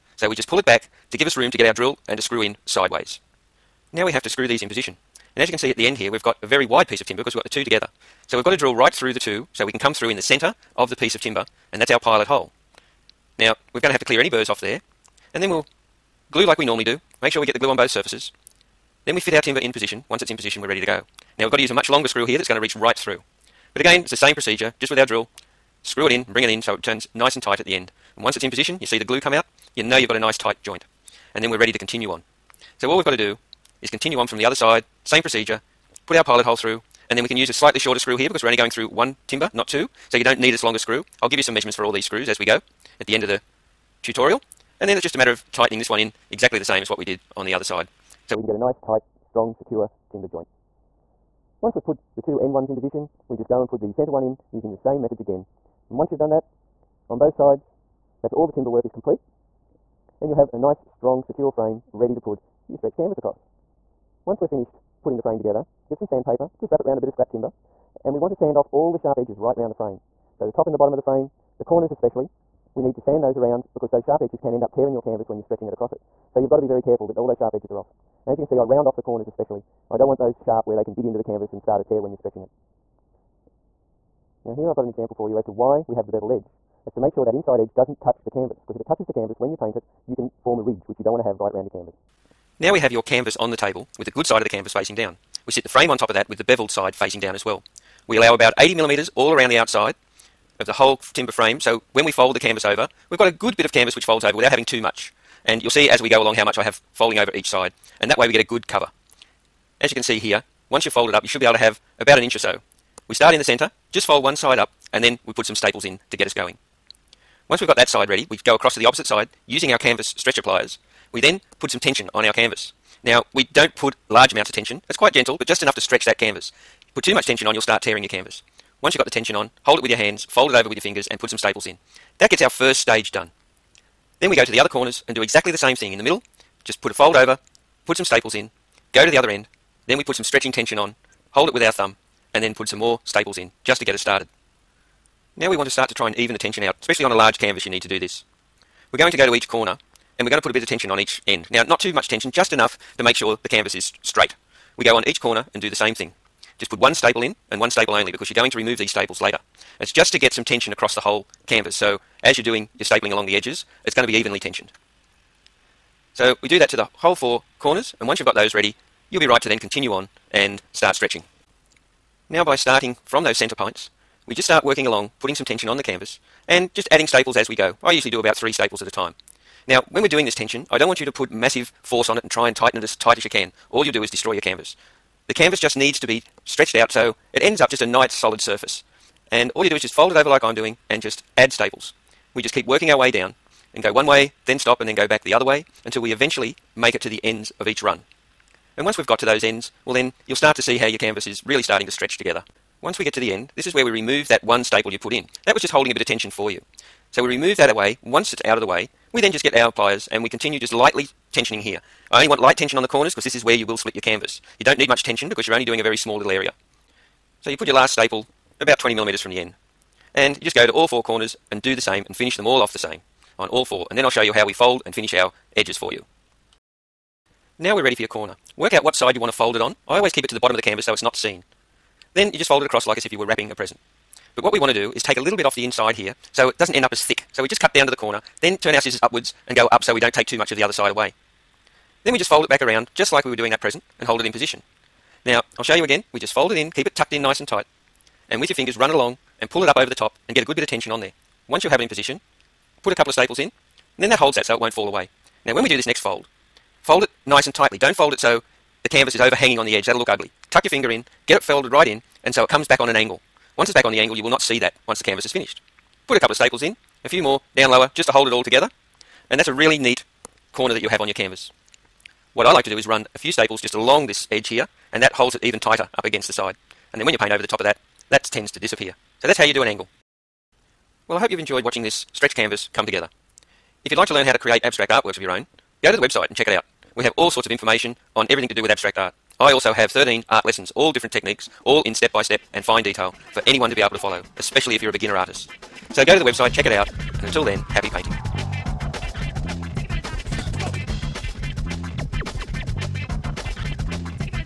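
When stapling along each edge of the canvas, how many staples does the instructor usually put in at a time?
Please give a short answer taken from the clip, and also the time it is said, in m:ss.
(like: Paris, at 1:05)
3, at 2:58.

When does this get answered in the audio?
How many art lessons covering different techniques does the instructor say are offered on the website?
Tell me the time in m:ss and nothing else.
4:49.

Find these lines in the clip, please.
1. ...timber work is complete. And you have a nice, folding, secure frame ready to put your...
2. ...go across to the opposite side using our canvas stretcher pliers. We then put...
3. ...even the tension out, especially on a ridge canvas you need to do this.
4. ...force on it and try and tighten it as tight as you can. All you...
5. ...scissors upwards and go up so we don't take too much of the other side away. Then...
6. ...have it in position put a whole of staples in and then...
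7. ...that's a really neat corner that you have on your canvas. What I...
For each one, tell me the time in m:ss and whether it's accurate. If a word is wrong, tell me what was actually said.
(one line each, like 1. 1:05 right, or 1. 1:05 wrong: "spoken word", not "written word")
1. 0:58 wrong: "strong", not "folding"
2. 1:58 right
3. 2:26 wrong: "large", not "ridge"
4. 3:01 right
5. 3:58 right
6. 4:11 wrong: "couple", not "whole"
7. 4:29 right.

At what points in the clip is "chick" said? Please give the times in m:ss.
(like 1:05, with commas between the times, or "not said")
not said.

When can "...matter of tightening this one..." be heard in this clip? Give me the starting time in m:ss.
0:45.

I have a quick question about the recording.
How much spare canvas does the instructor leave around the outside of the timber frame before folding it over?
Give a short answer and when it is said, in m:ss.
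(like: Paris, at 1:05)
80 millimeters, at 1:38.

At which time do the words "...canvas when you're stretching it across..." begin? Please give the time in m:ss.
1:15.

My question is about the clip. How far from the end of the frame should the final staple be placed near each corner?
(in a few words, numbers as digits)
20 millimeters.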